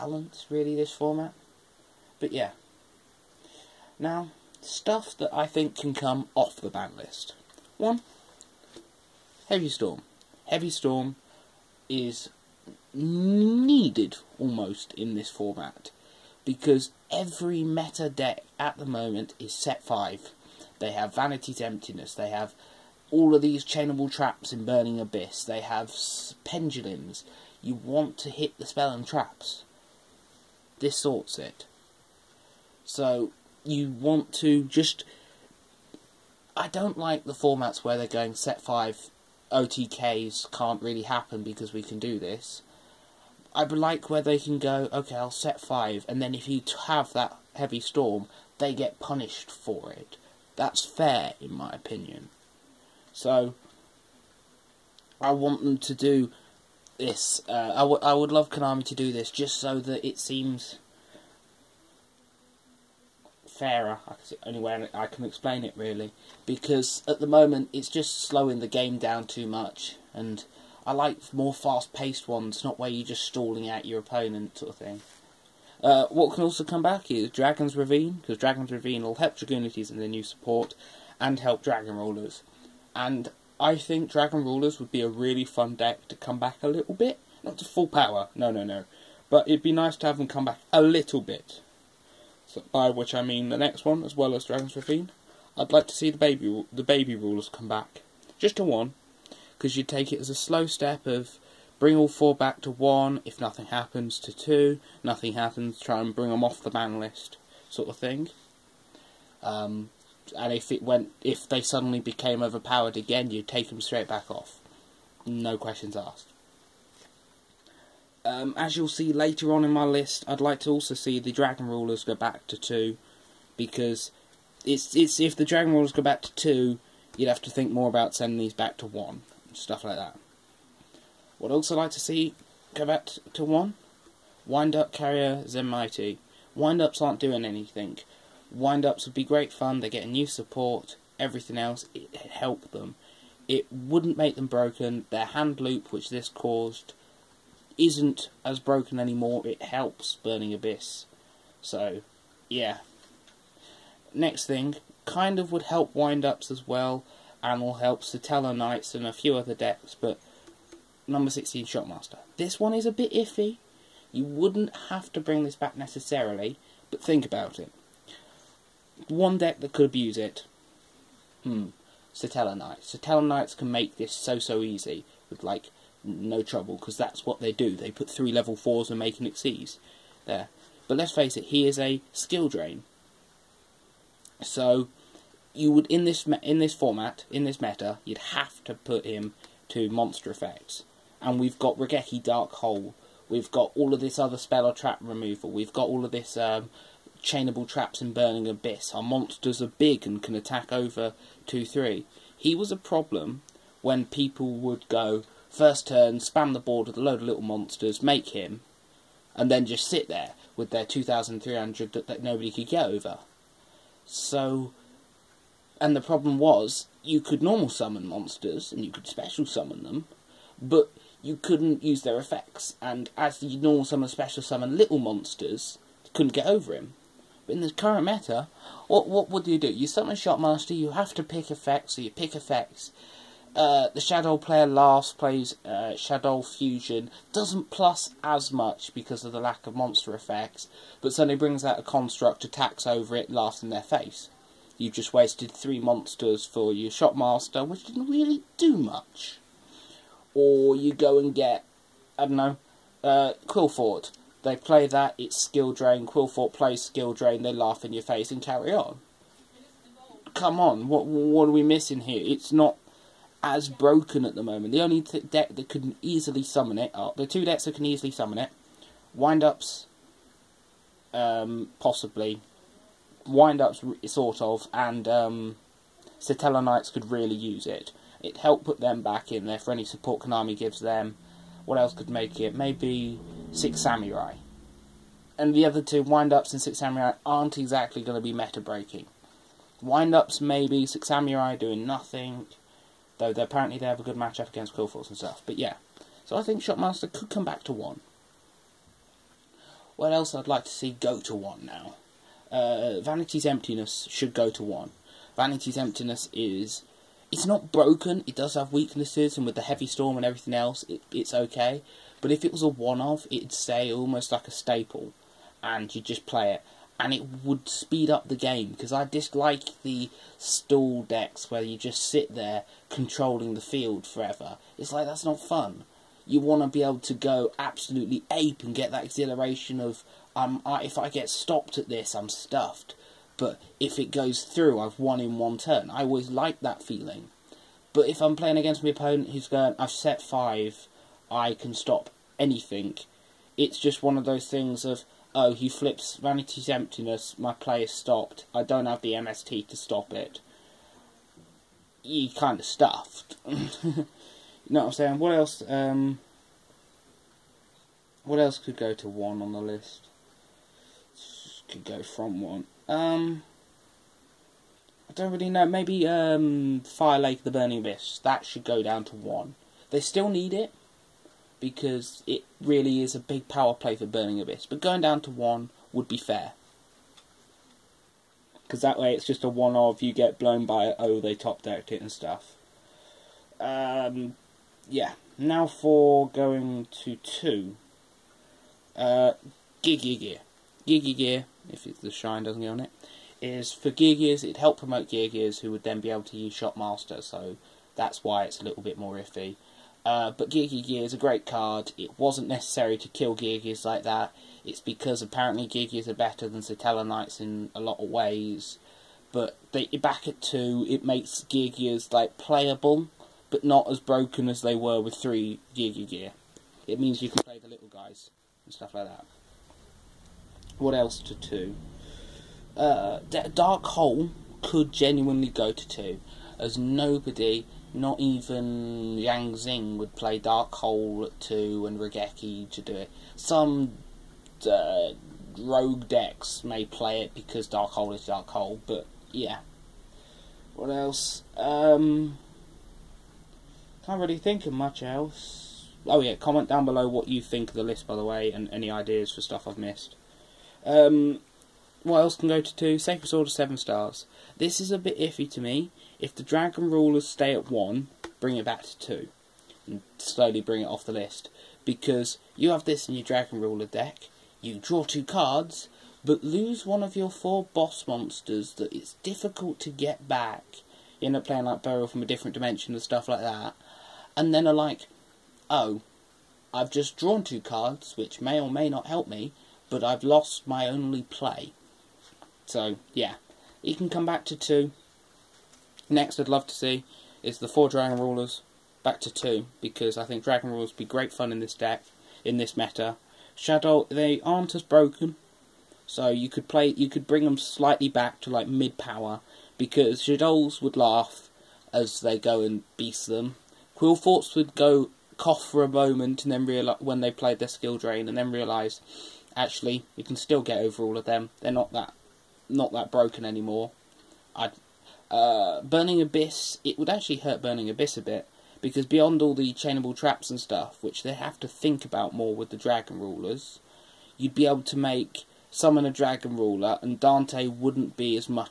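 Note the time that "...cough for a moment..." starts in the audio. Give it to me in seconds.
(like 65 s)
505 s.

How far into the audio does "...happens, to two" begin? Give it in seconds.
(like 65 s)
103 s.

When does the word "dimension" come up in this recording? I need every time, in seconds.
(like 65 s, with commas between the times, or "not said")
472 s.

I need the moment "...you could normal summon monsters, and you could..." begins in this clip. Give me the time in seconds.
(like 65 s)
217 s.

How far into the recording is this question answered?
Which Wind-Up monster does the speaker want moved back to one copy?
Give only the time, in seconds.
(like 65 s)
134 s.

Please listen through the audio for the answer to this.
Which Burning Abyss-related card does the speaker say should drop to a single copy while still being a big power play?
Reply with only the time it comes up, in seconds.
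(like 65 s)
366 s.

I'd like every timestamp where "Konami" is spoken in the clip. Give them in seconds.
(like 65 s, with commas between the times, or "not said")
58 s, 280 s.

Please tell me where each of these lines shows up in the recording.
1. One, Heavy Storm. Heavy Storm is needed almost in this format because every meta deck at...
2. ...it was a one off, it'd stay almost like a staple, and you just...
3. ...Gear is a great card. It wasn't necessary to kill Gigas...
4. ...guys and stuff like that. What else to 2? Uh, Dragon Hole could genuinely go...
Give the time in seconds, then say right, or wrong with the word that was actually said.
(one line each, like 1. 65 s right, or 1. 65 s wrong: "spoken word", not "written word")
1. 7 s right
2. 312 s right
3. 400 s right
4. 417 s wrong: "Dark", not "Dragon".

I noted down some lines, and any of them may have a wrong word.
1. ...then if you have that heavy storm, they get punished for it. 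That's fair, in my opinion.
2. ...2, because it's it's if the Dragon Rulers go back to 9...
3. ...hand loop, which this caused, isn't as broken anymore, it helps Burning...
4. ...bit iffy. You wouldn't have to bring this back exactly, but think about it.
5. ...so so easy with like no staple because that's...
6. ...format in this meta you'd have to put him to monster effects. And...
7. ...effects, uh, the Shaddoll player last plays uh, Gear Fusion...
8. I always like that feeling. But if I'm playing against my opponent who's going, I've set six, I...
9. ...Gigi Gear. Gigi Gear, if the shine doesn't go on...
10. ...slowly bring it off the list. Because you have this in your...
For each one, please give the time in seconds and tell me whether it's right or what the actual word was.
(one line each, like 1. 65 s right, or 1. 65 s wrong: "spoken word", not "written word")
1. 46 s right
2. 122 s wrong: "2", not "9"
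3. 145 s right
4. 162 s wrong: "necessarily", not "exactly"
5. 174 s wrong: "trouble", not "staple"
6. 186 s right
7. 232 s wrong: "Shaddoll", not "Gear"
8. 335 s wrong: "five", not "six"
9. 389 s right
10. 460 s right.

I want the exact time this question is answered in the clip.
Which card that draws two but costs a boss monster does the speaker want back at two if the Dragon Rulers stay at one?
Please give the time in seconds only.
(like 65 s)
452 s.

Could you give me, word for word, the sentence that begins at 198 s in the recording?
Our monsters are big and can attack over two three.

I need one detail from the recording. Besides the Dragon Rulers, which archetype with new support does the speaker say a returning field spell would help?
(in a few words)
Dragunities.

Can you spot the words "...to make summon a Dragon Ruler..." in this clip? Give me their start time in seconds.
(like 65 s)
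524 s.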